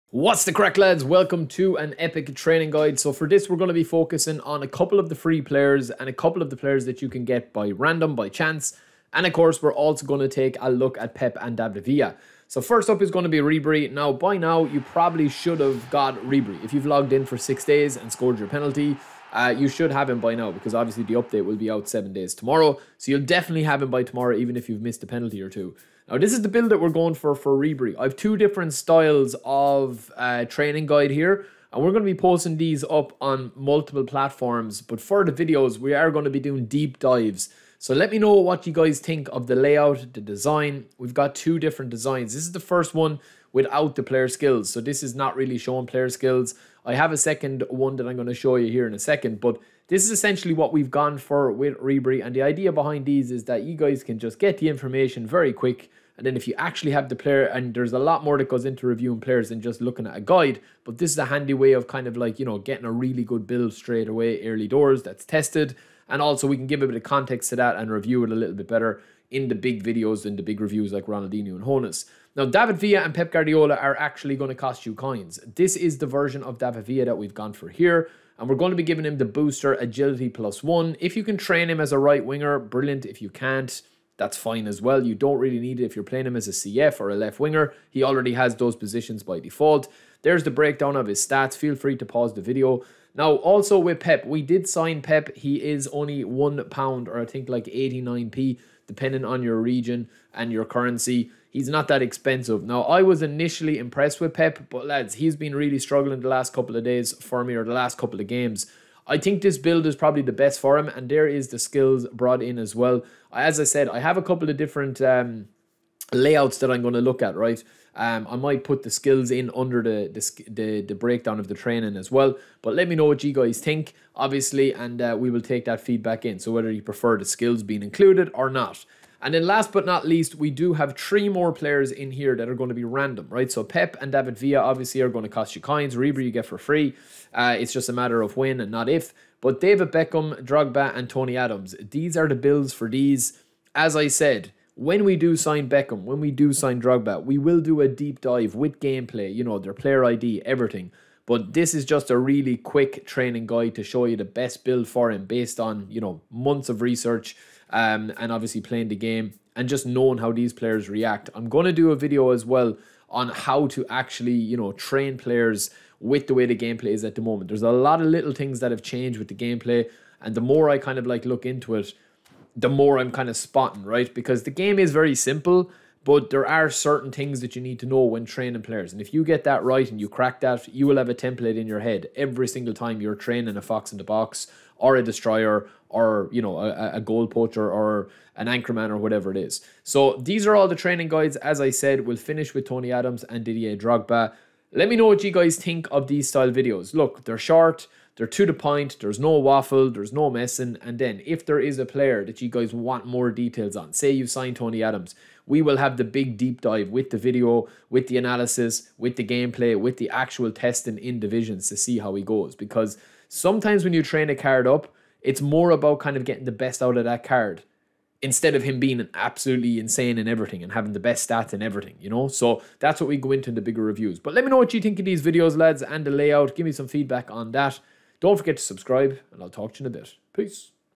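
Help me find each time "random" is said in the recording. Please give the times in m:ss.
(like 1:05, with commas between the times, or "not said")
0:07, 2:12.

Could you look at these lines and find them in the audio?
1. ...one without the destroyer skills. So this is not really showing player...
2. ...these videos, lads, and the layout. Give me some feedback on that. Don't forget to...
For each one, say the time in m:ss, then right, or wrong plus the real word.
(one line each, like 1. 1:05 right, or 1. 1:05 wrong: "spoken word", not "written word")
1. 0:42 wrong: "player", not "destroyer"
2. 3:45 right.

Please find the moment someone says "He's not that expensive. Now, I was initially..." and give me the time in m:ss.
1:41.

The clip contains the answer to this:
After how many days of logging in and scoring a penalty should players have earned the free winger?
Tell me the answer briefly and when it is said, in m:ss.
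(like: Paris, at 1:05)
6, at 0:17.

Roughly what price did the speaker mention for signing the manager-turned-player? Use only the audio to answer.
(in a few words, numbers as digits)
89p.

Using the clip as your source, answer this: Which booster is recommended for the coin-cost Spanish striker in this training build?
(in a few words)
agility plus one.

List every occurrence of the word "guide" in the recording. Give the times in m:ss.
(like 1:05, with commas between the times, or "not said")
0:02, 0:30, 1:00, 2:33, 3:11.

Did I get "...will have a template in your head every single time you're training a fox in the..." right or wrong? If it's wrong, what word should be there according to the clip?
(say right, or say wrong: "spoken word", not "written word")
right.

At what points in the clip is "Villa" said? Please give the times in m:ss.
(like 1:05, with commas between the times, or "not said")
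0:11, 1:12, 1:16, 2:14.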